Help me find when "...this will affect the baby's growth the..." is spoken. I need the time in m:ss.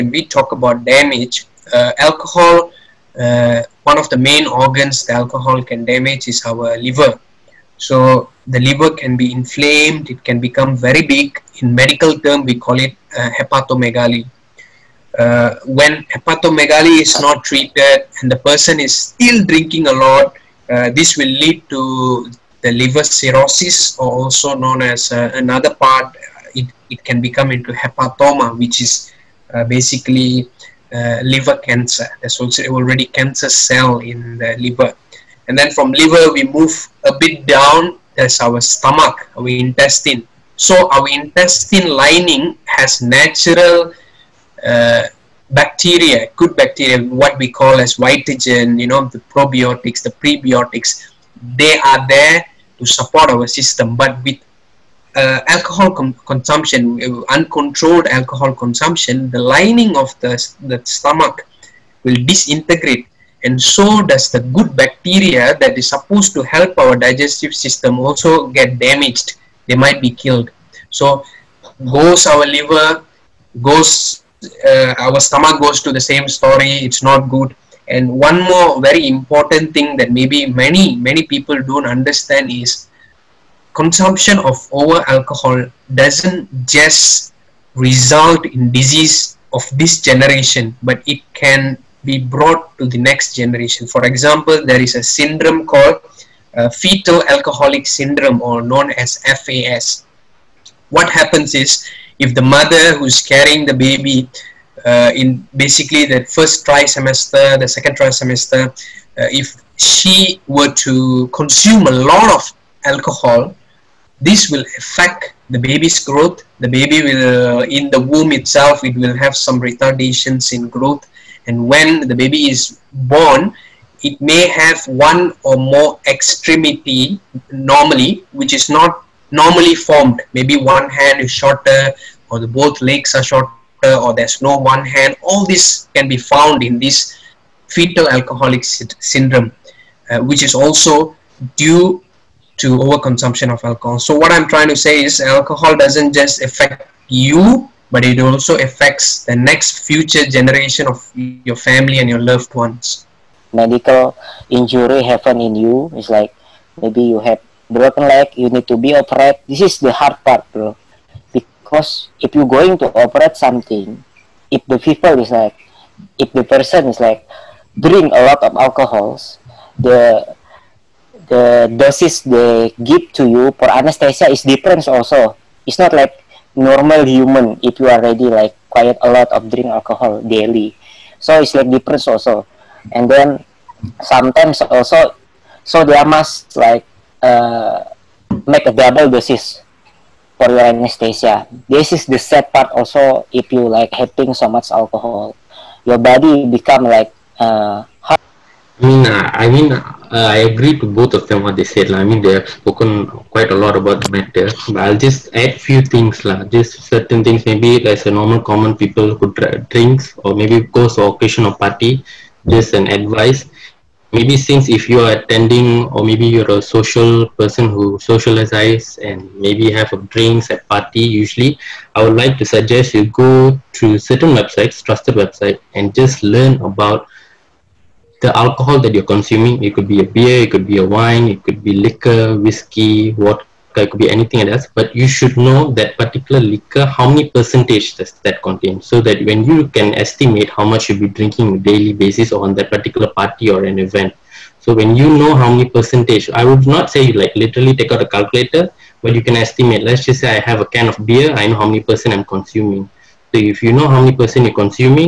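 1:54.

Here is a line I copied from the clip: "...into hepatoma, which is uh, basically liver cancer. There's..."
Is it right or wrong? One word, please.
right.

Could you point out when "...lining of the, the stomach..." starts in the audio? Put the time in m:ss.
0:59.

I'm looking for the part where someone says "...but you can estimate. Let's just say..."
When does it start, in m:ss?
4:09.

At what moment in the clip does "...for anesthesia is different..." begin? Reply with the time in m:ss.
2:53.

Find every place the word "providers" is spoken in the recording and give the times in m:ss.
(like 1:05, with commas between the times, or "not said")
not said.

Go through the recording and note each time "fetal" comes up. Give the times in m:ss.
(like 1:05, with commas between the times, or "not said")
1:36, 2:17.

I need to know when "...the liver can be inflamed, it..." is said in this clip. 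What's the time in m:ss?
0:08.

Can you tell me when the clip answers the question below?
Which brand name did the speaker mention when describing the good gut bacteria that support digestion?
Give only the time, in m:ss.
0:47.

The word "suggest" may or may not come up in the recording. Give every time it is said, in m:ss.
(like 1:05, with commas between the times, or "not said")
3:42.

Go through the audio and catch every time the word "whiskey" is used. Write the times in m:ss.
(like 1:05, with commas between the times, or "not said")
3:52.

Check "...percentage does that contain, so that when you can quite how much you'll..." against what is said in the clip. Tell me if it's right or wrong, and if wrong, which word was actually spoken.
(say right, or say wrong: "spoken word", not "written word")
wrong: "estimate", not "quite".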